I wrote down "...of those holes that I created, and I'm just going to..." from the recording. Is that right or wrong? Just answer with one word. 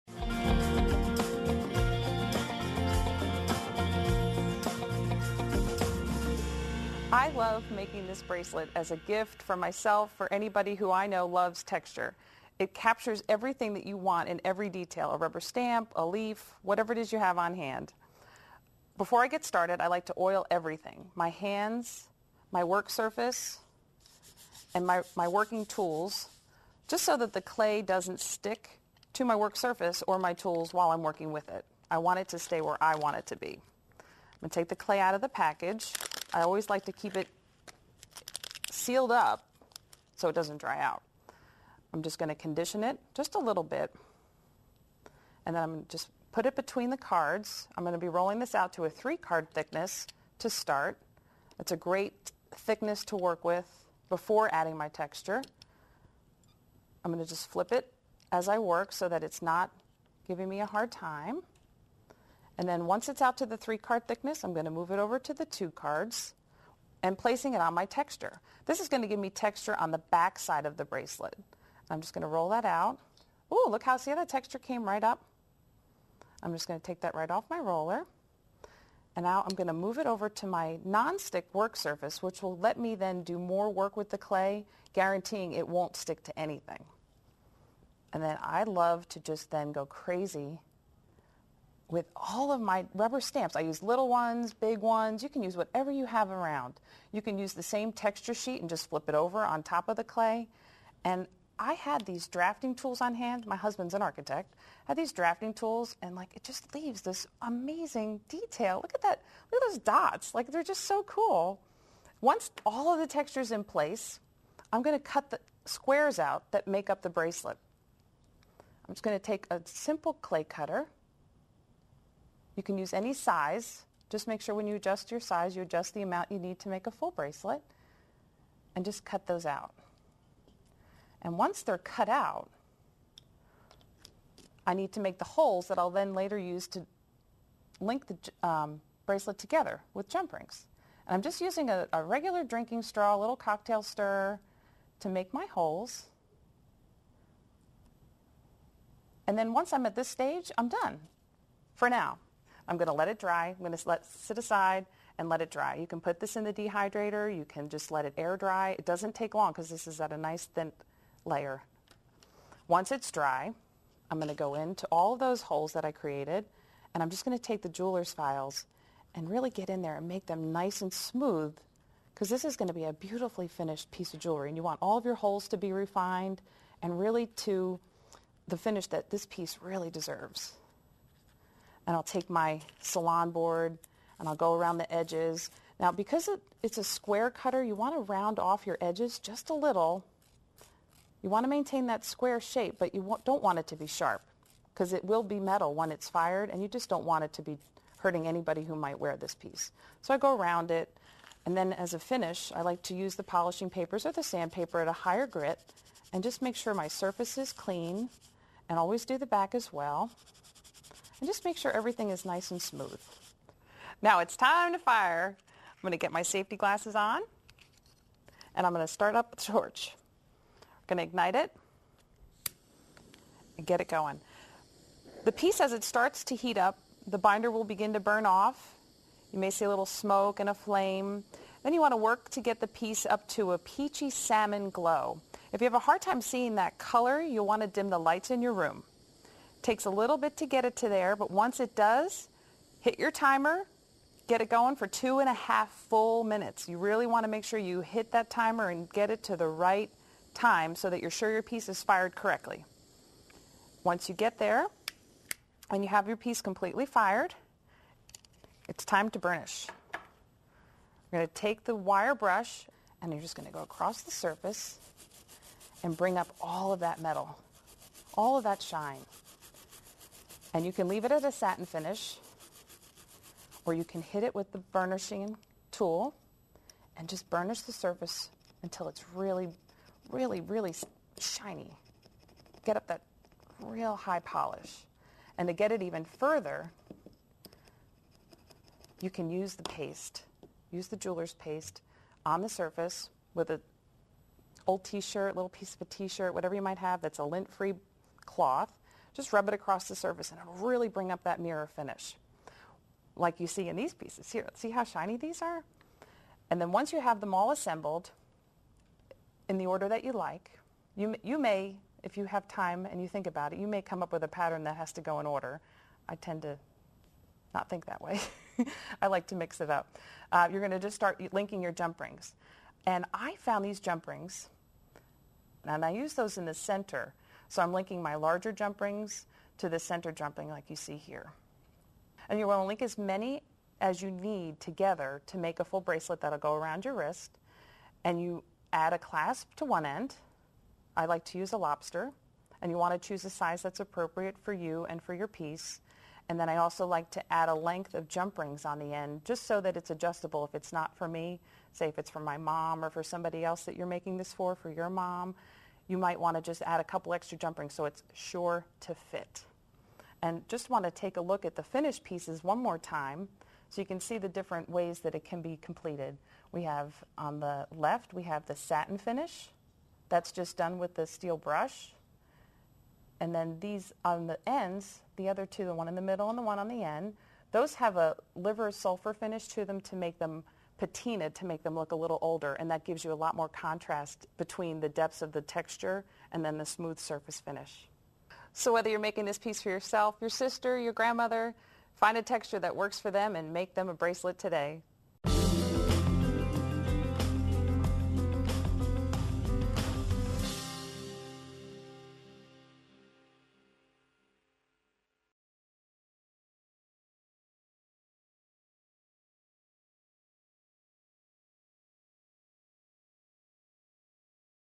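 right.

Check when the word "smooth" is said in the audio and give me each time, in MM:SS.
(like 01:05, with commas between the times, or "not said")
02:50, 03:32, 06:26.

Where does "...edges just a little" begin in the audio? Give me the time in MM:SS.
03:08.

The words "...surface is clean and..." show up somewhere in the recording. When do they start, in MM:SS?
03:26.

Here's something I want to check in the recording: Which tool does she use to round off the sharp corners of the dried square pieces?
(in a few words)
Salon board.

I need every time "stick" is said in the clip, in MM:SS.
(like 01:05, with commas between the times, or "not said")
00:28, 01:20, 01:25.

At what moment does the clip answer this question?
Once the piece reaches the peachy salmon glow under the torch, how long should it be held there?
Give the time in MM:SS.
04:04.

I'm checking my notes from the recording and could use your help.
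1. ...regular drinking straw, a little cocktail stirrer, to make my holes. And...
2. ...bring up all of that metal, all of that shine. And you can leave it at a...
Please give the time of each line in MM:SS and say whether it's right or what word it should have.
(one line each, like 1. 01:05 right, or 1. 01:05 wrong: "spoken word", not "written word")
1. 02:22 right
2. 04:25 right.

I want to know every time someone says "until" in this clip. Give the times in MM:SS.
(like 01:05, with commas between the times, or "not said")
04:38.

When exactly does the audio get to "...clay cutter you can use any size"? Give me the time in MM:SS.
02:00.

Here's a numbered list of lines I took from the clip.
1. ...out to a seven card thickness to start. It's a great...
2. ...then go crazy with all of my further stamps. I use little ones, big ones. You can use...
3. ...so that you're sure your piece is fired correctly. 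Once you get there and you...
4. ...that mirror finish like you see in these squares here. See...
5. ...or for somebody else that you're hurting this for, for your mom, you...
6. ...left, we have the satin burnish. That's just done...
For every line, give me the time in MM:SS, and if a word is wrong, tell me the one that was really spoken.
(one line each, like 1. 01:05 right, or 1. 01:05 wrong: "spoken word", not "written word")
1. 00:48 wrong: "three", not "seven"
2. 01:29 wrong: "rubber", not "further"
3. 04:10 right
4. 05:01 wrong: "pieces", not "squares"
5. 05:52 wrong: "making", not "hurting"
6. 06:07 wrong: "finish", not "burnish".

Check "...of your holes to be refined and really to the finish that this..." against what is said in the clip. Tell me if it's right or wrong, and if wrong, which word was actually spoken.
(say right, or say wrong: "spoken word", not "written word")
right.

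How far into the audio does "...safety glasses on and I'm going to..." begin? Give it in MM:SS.
03:36.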